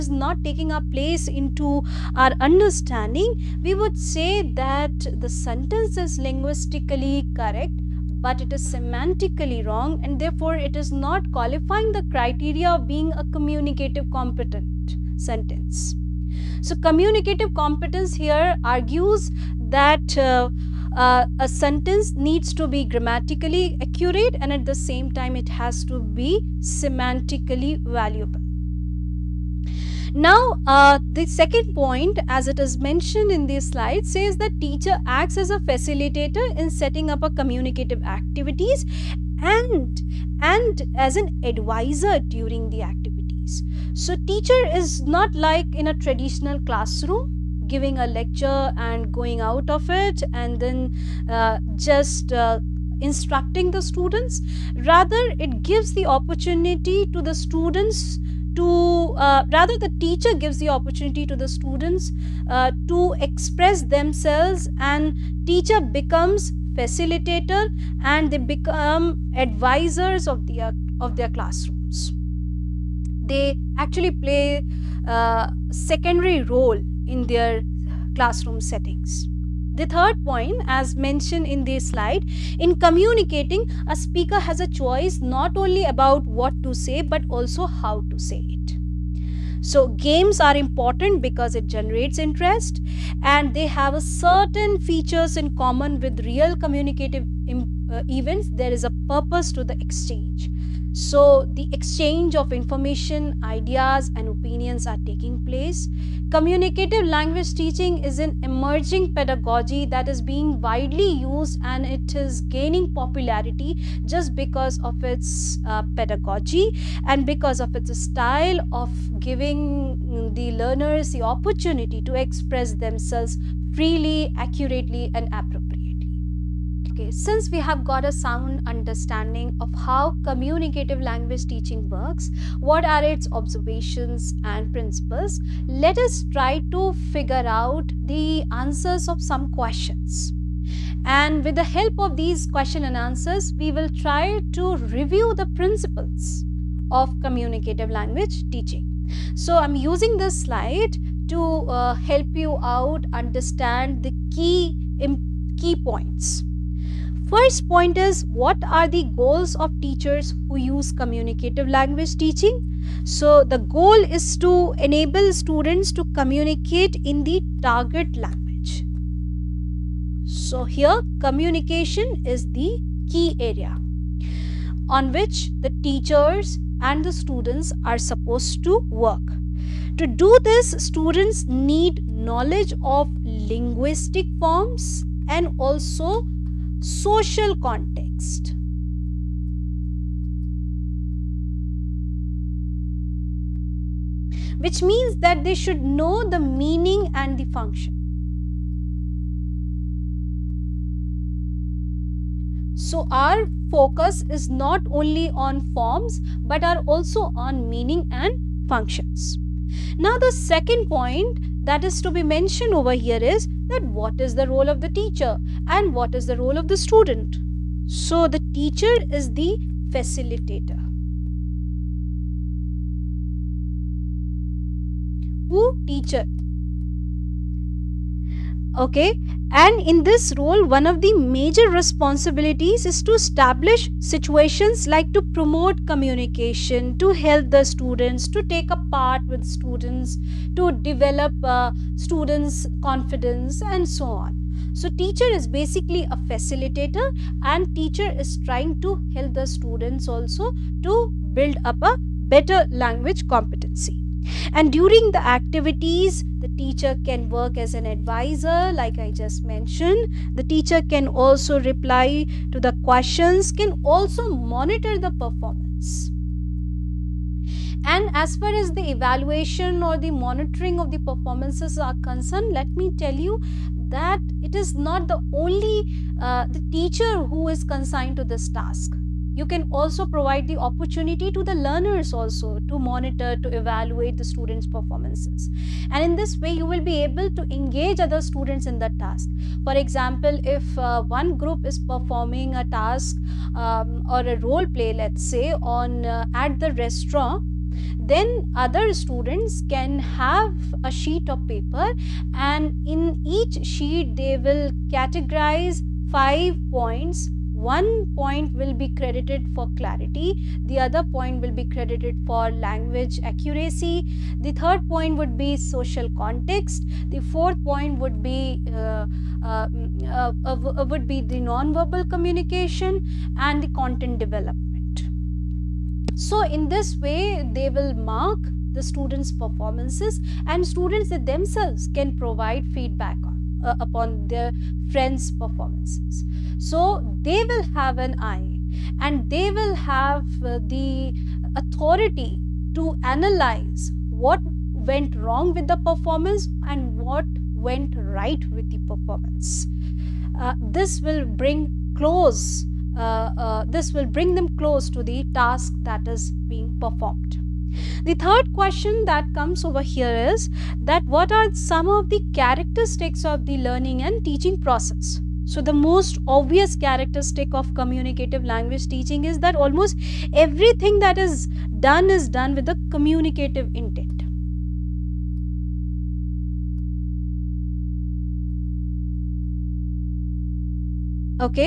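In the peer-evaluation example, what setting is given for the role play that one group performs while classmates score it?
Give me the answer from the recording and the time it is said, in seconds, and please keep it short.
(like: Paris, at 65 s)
at the restaurant, at 296 s.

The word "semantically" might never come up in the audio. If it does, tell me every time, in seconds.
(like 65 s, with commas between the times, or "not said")
8 s, 26 s.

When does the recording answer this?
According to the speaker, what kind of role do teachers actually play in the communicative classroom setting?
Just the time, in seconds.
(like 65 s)
75 s.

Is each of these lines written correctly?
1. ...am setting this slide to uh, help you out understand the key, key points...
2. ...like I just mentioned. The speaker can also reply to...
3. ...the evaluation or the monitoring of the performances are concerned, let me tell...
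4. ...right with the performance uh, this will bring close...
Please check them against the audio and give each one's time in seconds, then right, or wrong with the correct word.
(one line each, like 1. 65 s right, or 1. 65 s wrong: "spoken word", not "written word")
1. 149 s wrong: "using", not "setting"
2. 258 s wrong: "teacher", not "speaker"
3. 268 s right
4. 347 s right.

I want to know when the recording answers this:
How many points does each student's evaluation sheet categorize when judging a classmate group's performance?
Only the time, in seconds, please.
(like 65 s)
306 s.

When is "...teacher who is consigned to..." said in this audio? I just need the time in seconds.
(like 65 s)
276 s.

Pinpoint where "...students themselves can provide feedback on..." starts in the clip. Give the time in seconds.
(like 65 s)
330 s.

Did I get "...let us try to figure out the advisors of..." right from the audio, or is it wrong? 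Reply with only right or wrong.
wrong.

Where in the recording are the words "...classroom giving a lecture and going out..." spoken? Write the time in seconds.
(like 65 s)
46 s.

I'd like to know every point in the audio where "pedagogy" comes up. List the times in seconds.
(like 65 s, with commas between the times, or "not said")
109 s, 115 s.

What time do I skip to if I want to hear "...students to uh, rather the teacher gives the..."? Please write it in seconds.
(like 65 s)
57 s.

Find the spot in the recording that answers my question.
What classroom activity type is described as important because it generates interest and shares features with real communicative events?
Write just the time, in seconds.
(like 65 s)
89 s.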